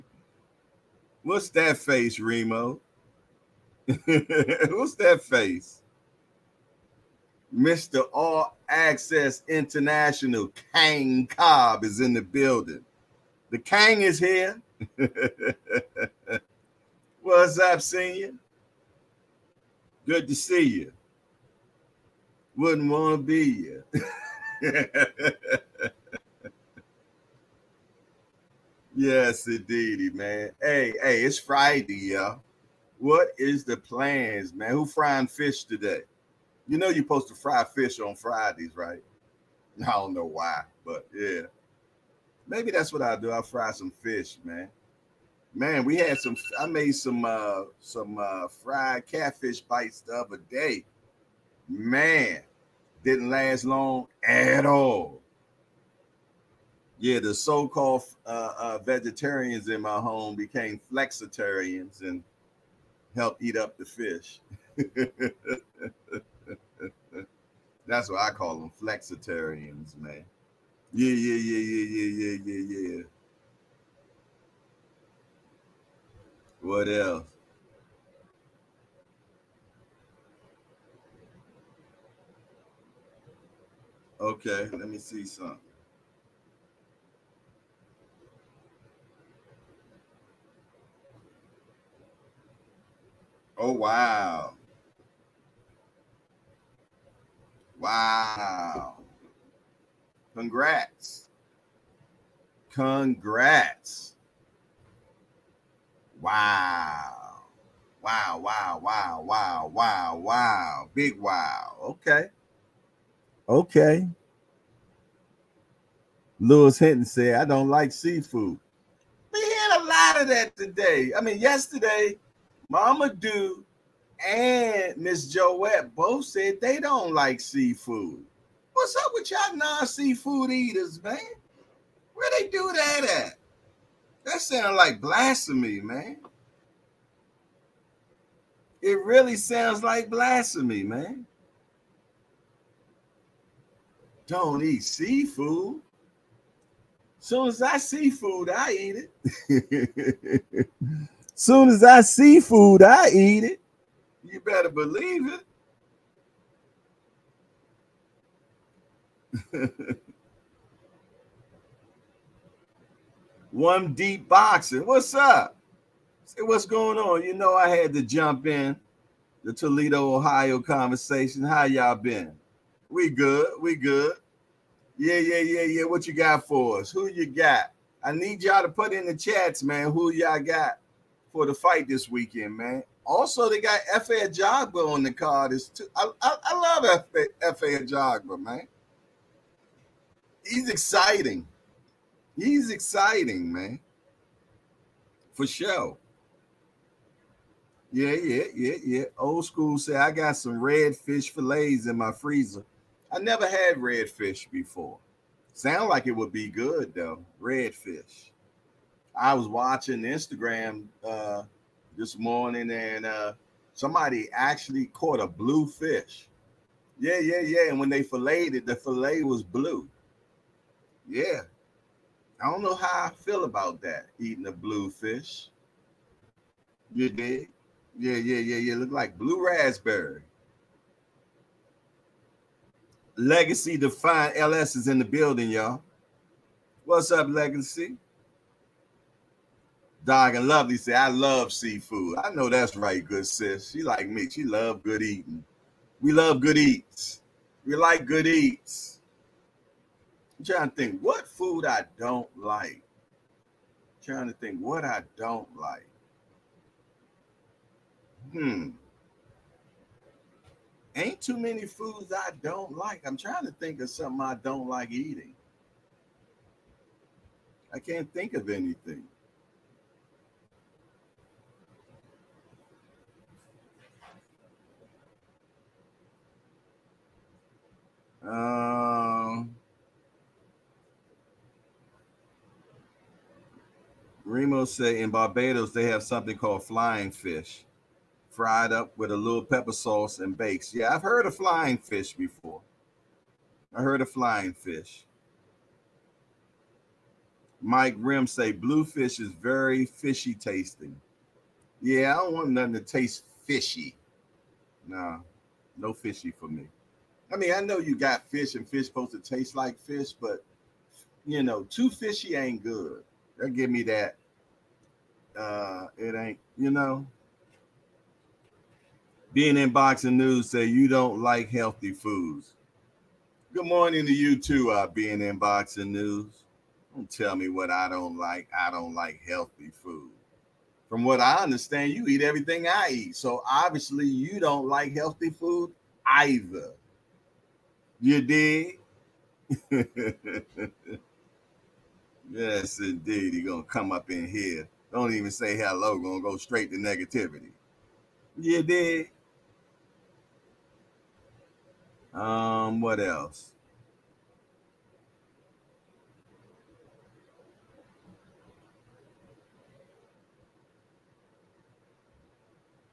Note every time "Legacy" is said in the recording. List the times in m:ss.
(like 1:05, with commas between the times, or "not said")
3:53, 3:57.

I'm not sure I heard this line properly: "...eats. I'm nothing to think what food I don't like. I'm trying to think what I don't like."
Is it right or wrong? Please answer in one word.
wrong.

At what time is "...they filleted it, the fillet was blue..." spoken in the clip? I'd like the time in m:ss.
3:37.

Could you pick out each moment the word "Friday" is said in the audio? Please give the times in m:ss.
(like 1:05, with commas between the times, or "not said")
0:31, 0:38.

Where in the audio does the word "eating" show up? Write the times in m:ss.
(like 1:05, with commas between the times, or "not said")
3:44, 4:05, 4:24.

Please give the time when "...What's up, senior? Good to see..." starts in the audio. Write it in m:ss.
0:17.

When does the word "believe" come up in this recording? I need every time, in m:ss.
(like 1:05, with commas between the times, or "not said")
2:34.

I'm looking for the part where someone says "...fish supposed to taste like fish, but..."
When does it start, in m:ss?
5:08.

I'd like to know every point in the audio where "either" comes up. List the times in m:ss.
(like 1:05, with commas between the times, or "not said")
5:36.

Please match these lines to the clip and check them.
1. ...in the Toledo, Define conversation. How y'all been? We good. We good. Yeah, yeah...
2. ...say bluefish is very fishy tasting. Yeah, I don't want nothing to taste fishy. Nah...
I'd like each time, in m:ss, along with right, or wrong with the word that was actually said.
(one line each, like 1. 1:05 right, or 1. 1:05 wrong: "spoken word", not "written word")
1. 2:48 wrong: "Ohio", not "Define"
2. 4:58 right.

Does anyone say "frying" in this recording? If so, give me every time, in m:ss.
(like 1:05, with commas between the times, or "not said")
0:34.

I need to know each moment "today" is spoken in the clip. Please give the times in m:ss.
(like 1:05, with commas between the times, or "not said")
0:35, 2:00.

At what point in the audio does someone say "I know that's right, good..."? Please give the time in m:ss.
4:02.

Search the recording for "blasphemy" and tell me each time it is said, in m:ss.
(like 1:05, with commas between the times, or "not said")
2:15, 2:20.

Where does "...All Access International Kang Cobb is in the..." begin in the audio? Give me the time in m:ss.
0:08.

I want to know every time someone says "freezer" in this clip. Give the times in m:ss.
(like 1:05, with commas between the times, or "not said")
3:22.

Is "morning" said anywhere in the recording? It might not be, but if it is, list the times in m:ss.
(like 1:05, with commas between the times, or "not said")
3:32, 5:23.